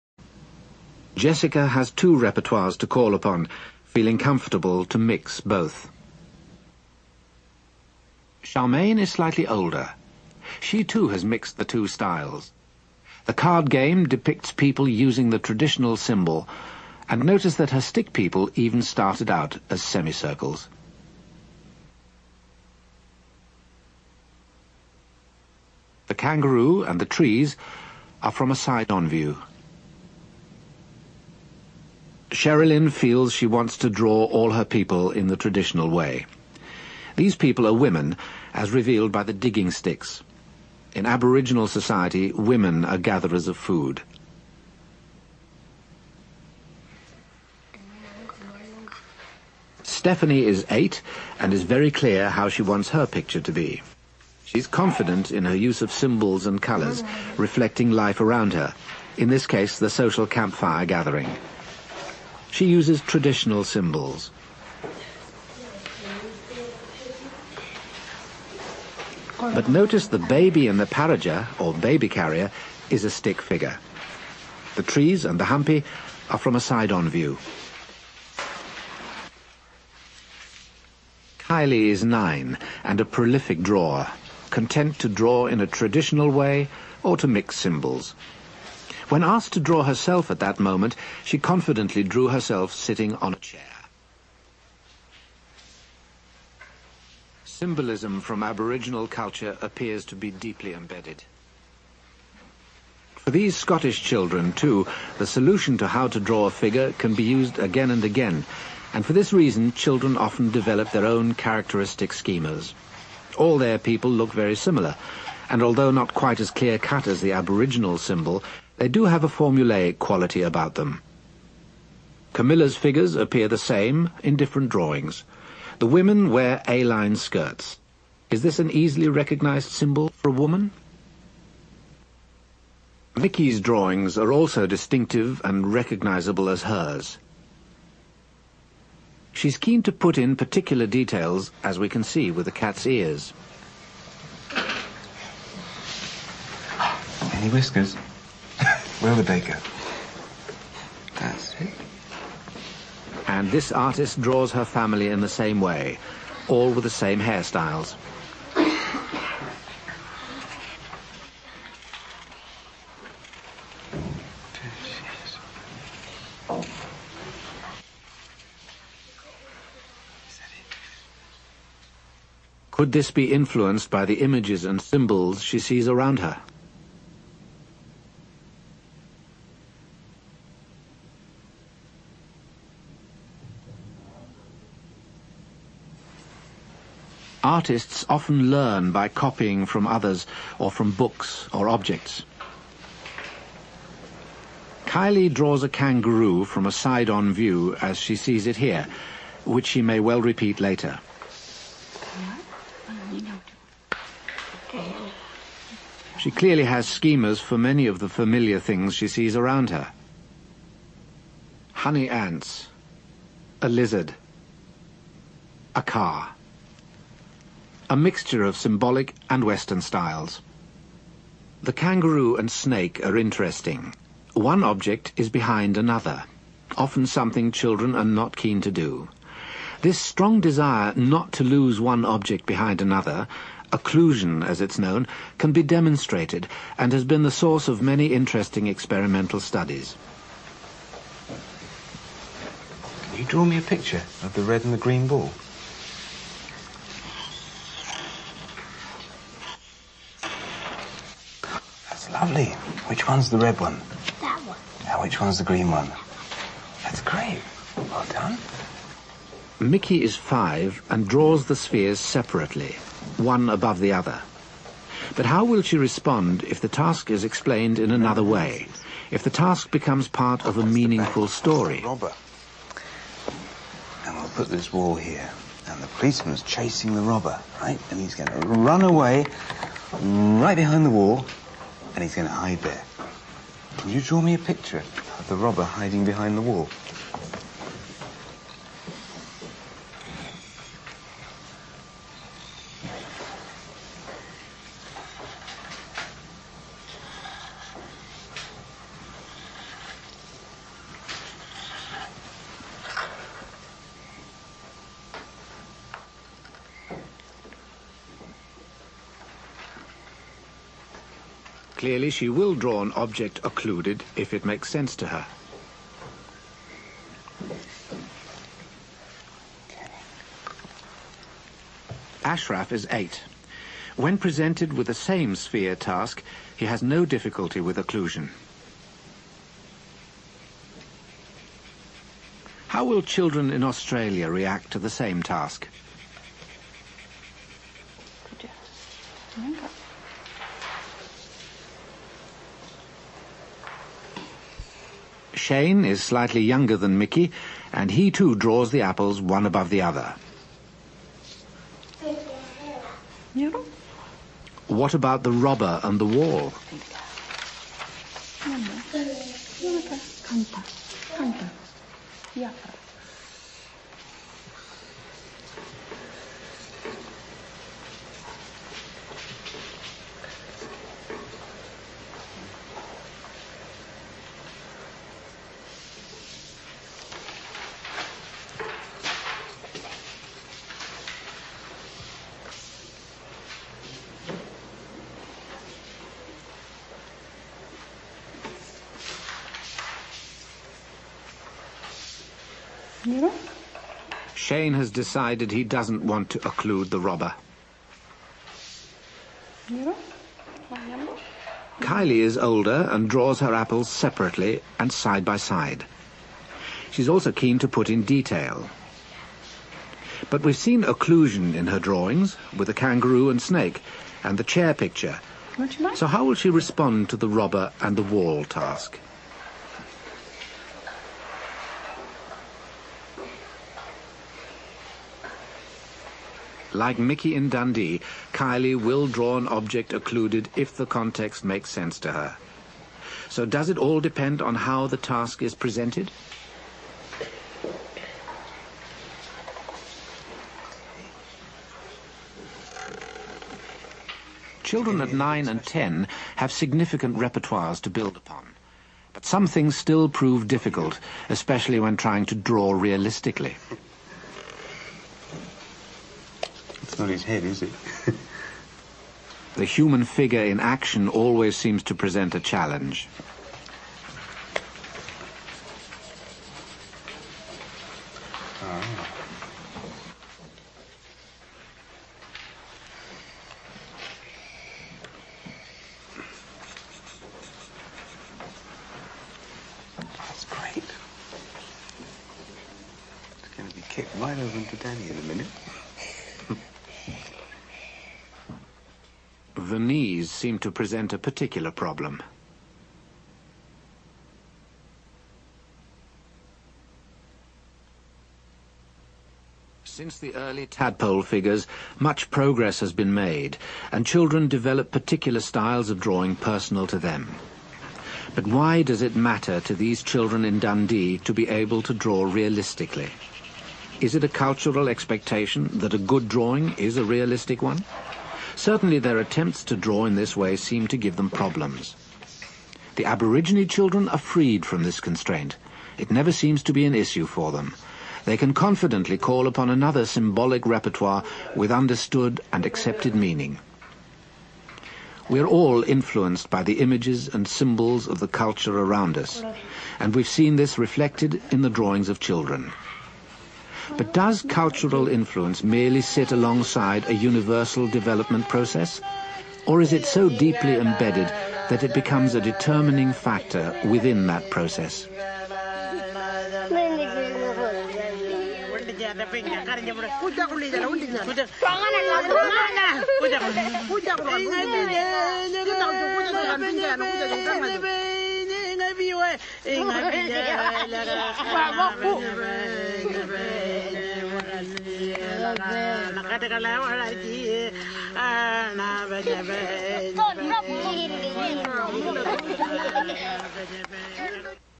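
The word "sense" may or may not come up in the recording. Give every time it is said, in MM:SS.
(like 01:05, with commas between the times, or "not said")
05:14, 07:11.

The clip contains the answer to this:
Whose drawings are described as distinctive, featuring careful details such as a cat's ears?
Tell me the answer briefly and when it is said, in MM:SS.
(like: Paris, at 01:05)
Vicky, at 02:13.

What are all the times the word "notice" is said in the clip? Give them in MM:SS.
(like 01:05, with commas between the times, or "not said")
00:17, 01:09.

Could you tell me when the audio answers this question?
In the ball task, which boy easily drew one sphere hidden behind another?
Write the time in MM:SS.
05:22.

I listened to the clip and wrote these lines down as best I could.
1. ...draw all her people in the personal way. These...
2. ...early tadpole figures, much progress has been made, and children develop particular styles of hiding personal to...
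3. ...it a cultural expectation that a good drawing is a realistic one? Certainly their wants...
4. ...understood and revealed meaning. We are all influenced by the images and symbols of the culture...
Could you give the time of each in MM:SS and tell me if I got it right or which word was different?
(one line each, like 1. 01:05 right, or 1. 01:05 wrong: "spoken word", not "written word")
1. 00:33 wrong: "traditional", not "personal"
2. 08:20 wrong: "drawing", not "hiding"
3. 08:34 wrong: "attempts", not "wants"
4. 08:51 wrong: "accepted", not "revealed".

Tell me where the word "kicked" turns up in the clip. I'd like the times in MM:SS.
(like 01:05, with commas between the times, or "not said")
08:03.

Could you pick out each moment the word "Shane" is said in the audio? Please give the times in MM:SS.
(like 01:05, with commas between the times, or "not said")
05:45, 06:34.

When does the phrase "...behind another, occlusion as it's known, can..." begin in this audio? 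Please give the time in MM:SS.
03:52.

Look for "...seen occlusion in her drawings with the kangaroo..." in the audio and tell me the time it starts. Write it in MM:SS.
06:50.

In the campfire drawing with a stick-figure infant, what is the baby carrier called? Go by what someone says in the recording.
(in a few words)
Paraja.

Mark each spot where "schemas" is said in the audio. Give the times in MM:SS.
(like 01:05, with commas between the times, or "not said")
01:52, 03:26.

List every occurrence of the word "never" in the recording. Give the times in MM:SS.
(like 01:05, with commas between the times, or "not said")
08:46.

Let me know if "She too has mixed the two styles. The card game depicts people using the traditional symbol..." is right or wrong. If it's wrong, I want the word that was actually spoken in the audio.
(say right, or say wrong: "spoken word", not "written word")
right.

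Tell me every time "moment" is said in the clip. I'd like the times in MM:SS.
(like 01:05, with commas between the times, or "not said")
01:30.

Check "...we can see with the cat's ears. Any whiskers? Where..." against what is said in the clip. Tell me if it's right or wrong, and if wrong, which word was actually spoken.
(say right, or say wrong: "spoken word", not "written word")
right.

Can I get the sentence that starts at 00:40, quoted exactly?
In Aboriginal society, women are gatherers of food.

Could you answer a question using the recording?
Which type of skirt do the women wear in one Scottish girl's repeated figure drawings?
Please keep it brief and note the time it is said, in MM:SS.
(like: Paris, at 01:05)
A-line skirts, at 02:06.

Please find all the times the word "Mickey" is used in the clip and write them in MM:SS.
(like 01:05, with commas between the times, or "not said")
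04:19, 05:46, 07:06.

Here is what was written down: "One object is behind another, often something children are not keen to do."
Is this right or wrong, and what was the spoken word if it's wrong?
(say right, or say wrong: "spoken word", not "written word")
right.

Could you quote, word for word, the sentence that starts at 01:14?
The trees and the humpy are from a side-on view.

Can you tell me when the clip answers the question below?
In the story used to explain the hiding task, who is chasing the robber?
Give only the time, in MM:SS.
04:35.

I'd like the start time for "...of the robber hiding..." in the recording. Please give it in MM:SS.
04:45.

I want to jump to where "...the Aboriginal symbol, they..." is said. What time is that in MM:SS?
01:57.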